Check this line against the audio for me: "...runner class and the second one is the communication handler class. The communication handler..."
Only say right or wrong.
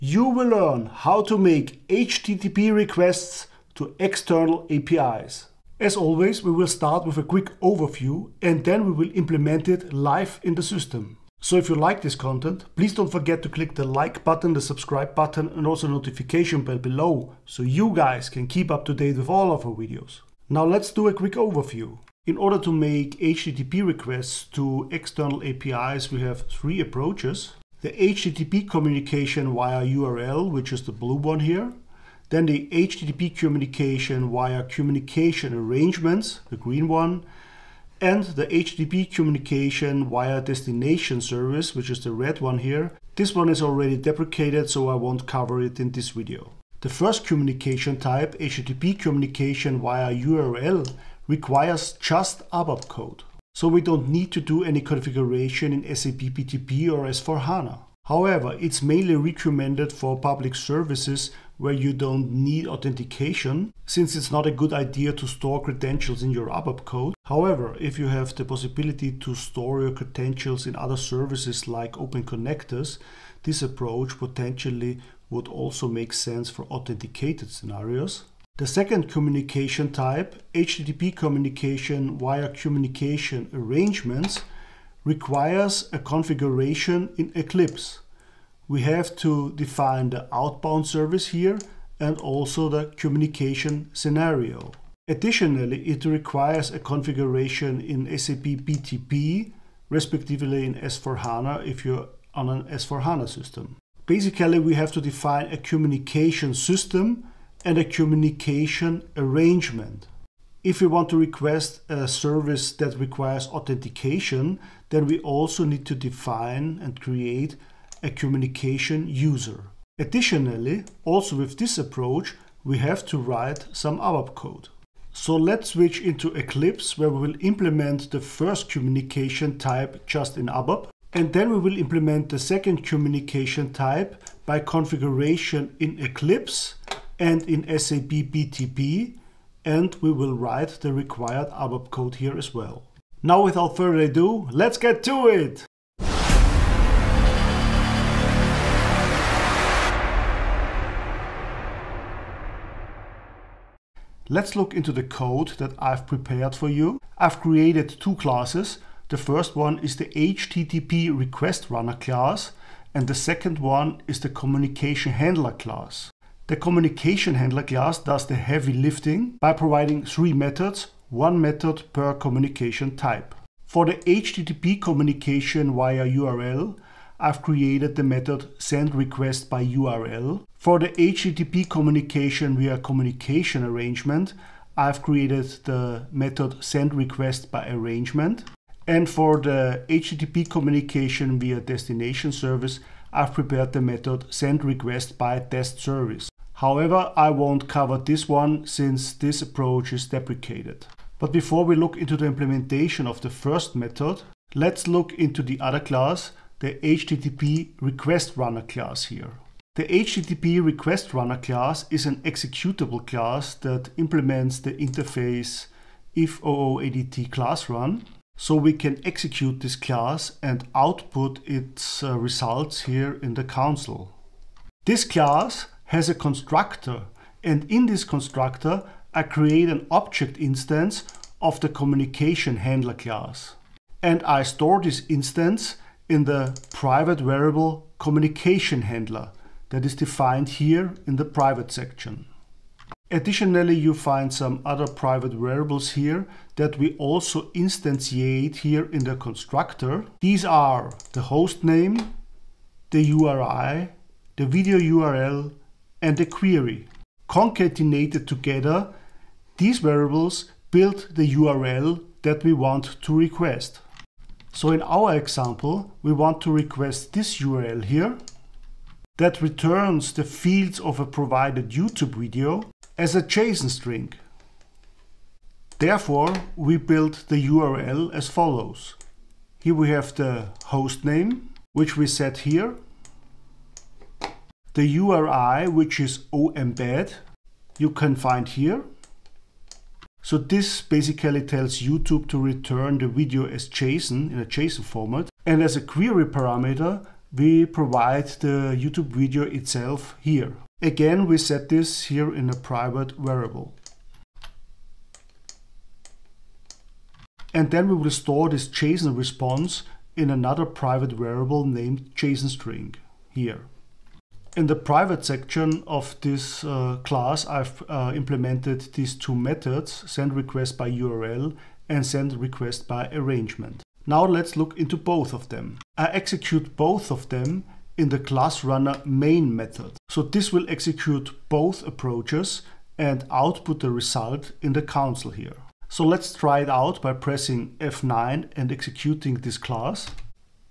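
right.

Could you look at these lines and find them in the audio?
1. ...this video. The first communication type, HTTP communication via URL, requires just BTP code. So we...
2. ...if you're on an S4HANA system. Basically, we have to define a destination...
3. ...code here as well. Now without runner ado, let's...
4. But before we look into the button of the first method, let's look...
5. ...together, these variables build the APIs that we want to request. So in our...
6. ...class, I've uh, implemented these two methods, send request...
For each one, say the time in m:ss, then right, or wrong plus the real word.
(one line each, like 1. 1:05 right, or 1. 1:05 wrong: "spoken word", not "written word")
1. 0:45 wrong: "ABAP", not "BTP"
2. 1:41 wrong: "communication", not "destination"
3. 2:21 wrong: "further", not "runner"
4. 3:21 wrong: "implementation", not "button"
5. 4:18 wrong: "URL", not "APIs"
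6. 5:17 right.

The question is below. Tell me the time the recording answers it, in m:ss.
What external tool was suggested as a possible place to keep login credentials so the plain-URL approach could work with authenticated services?
1:11.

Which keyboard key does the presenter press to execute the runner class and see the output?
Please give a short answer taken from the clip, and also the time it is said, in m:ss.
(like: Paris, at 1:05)
F9, at 5:37.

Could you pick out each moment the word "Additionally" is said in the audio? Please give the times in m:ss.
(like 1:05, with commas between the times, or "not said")
1:35, 1:59, 4:03.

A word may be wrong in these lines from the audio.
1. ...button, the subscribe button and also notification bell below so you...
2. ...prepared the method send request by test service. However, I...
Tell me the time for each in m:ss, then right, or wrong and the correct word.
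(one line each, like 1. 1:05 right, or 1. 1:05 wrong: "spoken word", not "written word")
1. 0:14 right
2. 3:13 right.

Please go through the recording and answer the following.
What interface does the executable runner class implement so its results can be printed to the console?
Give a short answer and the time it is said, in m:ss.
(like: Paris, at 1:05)
if OOADT class run, at 3:36.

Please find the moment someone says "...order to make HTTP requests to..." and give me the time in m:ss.
0:22.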